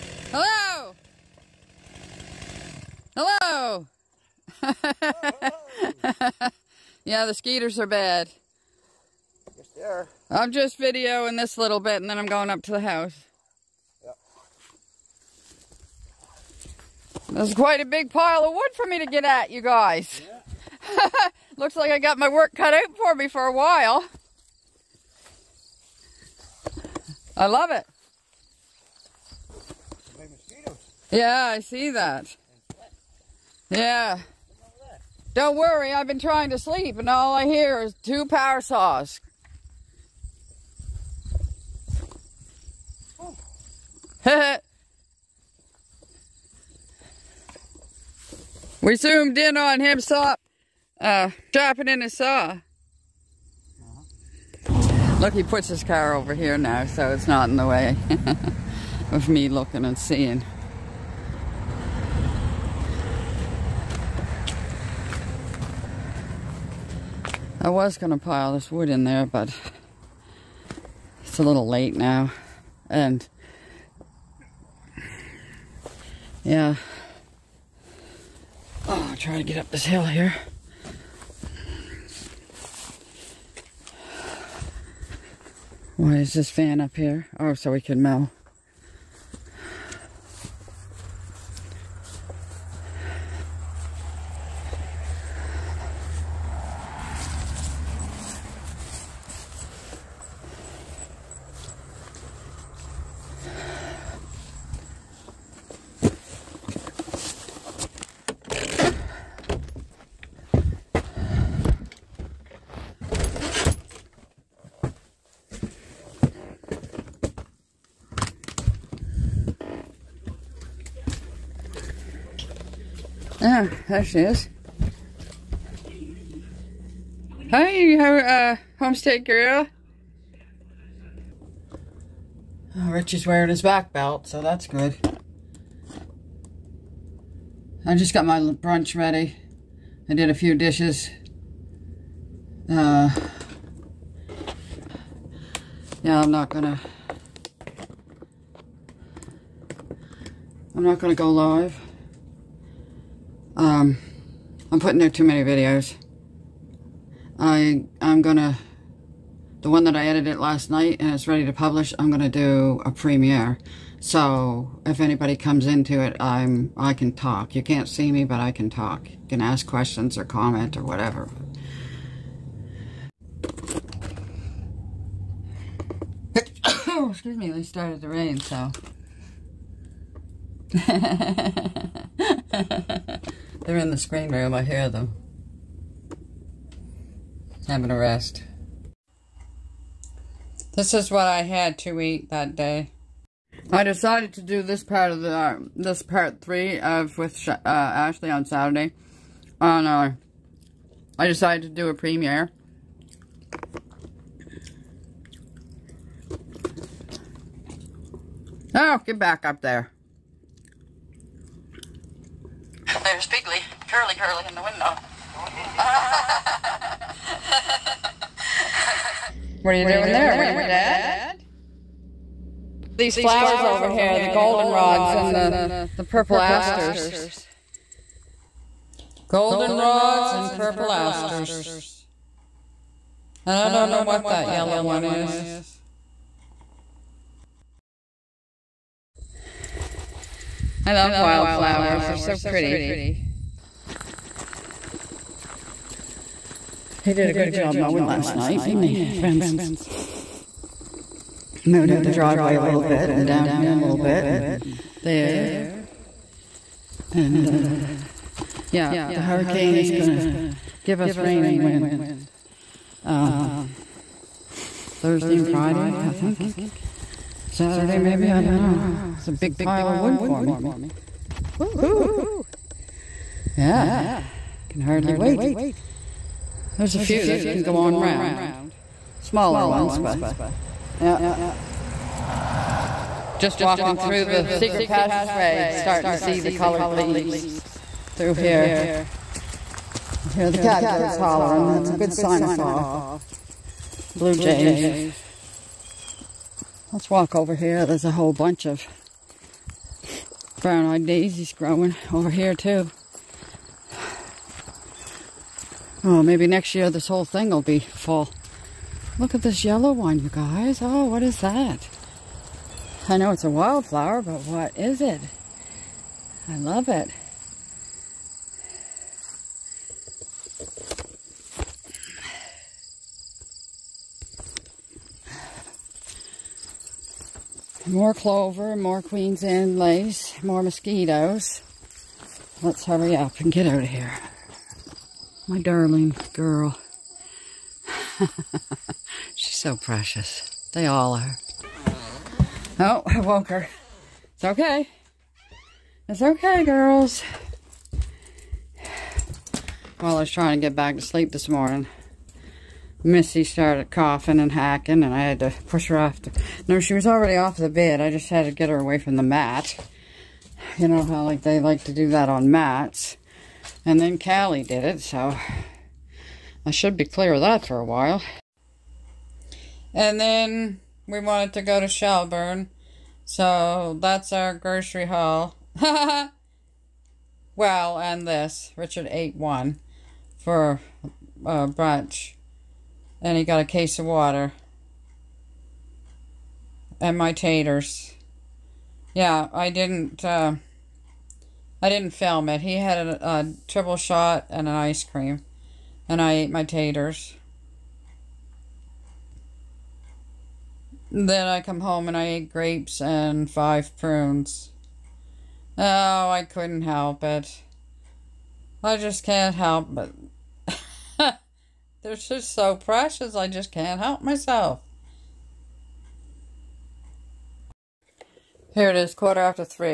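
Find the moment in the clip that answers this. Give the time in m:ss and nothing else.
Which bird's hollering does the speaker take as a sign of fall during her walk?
4:50.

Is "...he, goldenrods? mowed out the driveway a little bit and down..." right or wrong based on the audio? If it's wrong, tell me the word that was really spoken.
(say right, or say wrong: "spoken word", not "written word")
wrong: "friends", not "goldenrods".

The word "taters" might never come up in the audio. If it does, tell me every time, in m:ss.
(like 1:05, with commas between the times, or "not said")
6:27, 6:36.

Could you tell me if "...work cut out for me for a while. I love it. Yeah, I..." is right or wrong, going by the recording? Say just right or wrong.
right.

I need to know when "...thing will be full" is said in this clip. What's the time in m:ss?
5:07.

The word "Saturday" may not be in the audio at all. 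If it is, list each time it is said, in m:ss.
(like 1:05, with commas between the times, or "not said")
3:18, 4:27.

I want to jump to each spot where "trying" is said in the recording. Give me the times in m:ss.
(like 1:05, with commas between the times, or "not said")
0:36, 5:50.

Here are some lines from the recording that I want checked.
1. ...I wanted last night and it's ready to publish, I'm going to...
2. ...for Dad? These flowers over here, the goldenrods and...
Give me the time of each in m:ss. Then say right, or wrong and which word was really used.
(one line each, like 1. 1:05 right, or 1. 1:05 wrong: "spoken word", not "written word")
1. 2:39 wrong: "edited", not "wanted"
2. 3:40 right.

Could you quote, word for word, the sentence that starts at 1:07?
I was going to pile this wood in there, but it's a little late now.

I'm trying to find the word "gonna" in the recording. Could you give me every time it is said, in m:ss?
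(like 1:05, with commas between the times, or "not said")
2:26, 2:30.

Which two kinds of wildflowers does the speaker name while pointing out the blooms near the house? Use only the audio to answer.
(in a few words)
Goldenrods and purple asters.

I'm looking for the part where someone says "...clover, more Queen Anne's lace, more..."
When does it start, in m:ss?
5:28.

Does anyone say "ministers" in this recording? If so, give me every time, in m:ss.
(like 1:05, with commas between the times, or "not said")
not said.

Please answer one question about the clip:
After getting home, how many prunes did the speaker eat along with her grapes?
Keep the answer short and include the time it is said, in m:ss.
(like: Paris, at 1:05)
5, at 6:43.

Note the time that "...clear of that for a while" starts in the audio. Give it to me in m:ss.
6:07.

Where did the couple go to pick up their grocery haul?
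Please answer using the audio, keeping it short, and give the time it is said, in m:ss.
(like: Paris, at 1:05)
Shelburne, at 6:11.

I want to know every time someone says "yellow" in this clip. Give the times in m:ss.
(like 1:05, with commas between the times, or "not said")
3:54, 5:09.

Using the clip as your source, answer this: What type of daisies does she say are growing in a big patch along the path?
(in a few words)
Brown-eyed daisies.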